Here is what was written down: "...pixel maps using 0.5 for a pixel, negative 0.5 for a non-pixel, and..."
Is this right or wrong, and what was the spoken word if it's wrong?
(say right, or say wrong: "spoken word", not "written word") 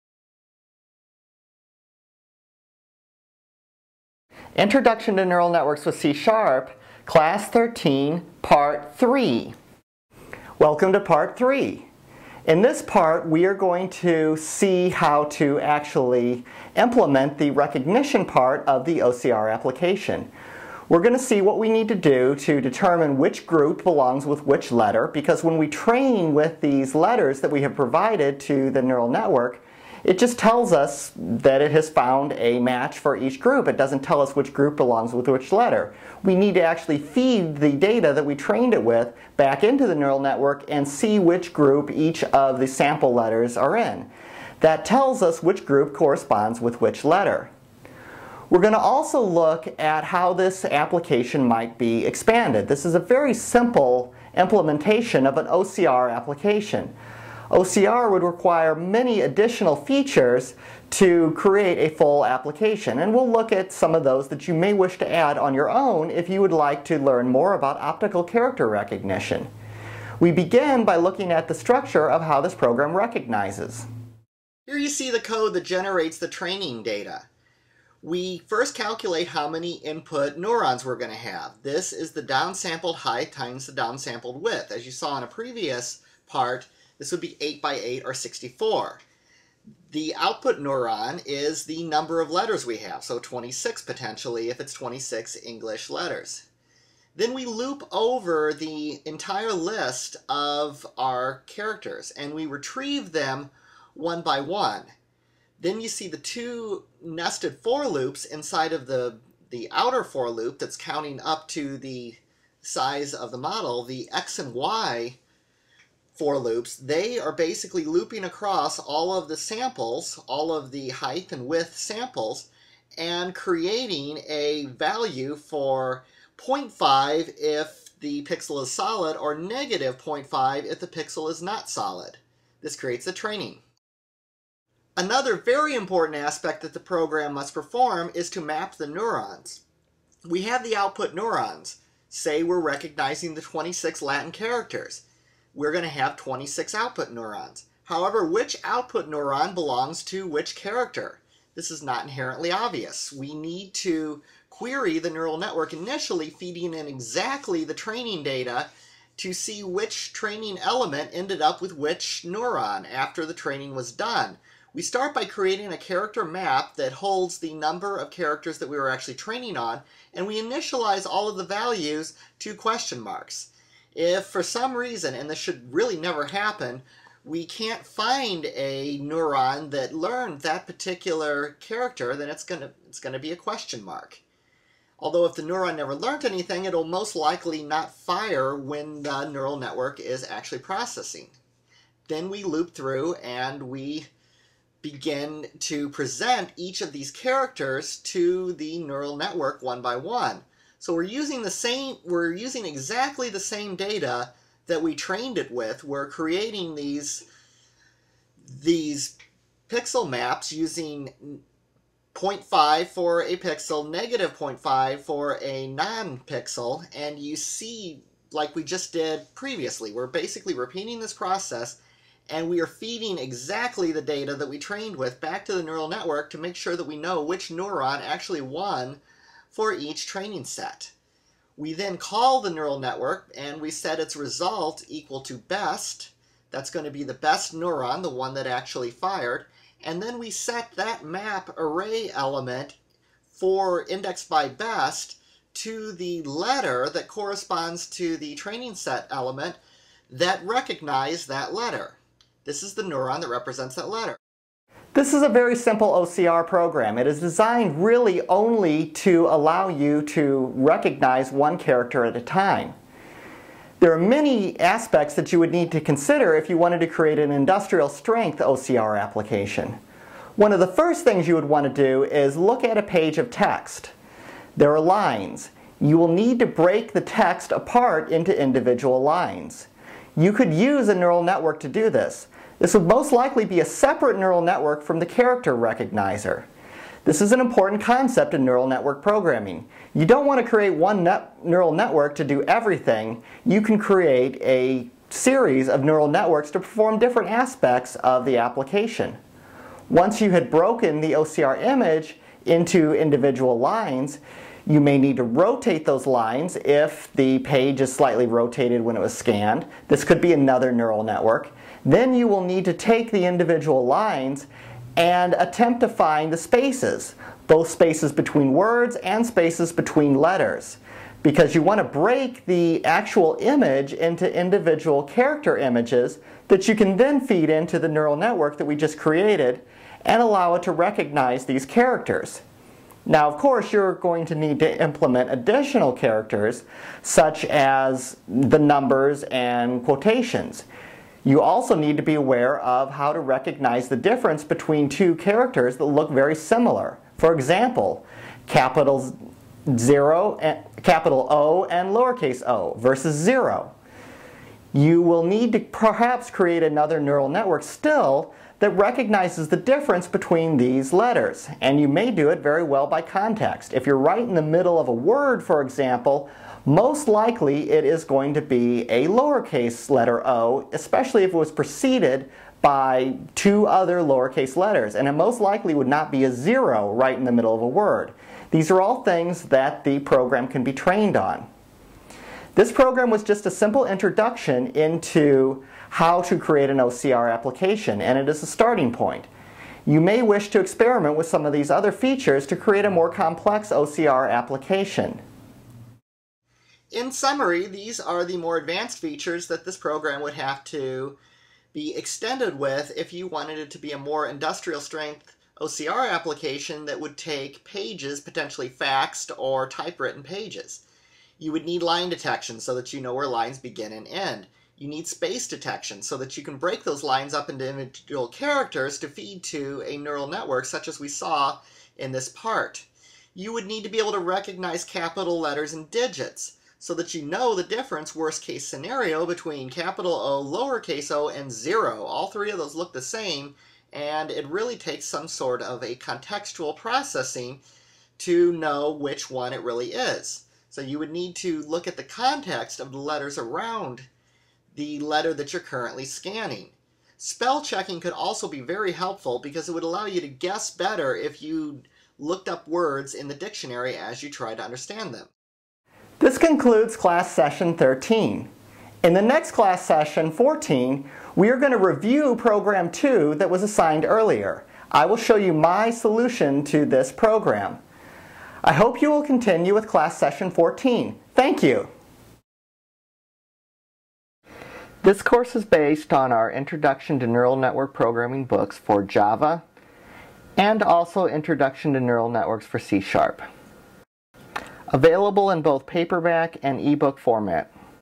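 right.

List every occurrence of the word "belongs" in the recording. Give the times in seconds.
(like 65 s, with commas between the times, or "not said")
23 s, 34 s, 149 s.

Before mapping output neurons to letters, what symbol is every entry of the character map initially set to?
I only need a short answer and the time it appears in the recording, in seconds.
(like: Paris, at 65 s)
question marks, at 172 s.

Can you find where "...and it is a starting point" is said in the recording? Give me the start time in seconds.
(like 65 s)
388 s.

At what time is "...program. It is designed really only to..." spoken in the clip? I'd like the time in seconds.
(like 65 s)
256 s.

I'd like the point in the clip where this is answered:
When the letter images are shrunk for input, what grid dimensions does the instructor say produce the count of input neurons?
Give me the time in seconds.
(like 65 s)
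87 s.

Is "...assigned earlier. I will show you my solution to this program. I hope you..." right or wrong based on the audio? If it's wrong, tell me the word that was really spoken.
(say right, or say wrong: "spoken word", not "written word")
right.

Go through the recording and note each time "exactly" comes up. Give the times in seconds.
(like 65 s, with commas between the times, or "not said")
156 s, 202 s, 223 s.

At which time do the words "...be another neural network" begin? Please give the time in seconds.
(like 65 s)
310 s.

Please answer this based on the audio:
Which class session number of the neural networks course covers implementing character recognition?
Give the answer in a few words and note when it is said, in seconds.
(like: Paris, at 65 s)
13, at 7 s.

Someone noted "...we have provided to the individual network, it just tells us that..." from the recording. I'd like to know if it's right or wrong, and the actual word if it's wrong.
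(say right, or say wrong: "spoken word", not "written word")
wrong: "neural", not "individual".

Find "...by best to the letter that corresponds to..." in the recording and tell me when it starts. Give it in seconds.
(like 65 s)
244 s.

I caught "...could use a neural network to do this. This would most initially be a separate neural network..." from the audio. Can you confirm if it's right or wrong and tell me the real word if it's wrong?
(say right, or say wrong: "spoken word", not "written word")
wrong: "likely", not "initially".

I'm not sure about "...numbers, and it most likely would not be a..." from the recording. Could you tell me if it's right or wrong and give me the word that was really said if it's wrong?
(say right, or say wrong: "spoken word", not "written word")
wrong: "letters", not "numbers".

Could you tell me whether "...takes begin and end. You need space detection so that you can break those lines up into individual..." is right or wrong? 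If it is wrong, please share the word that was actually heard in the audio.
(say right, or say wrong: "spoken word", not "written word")
wrong: "lines", not "takes".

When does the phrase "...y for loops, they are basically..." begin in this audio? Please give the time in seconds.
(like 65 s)
114 s.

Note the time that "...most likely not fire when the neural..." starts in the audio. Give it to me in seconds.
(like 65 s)
186 s.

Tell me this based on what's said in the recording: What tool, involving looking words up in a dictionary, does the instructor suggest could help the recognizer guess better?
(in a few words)
Spell checking.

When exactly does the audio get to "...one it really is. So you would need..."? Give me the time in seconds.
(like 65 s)
439 s.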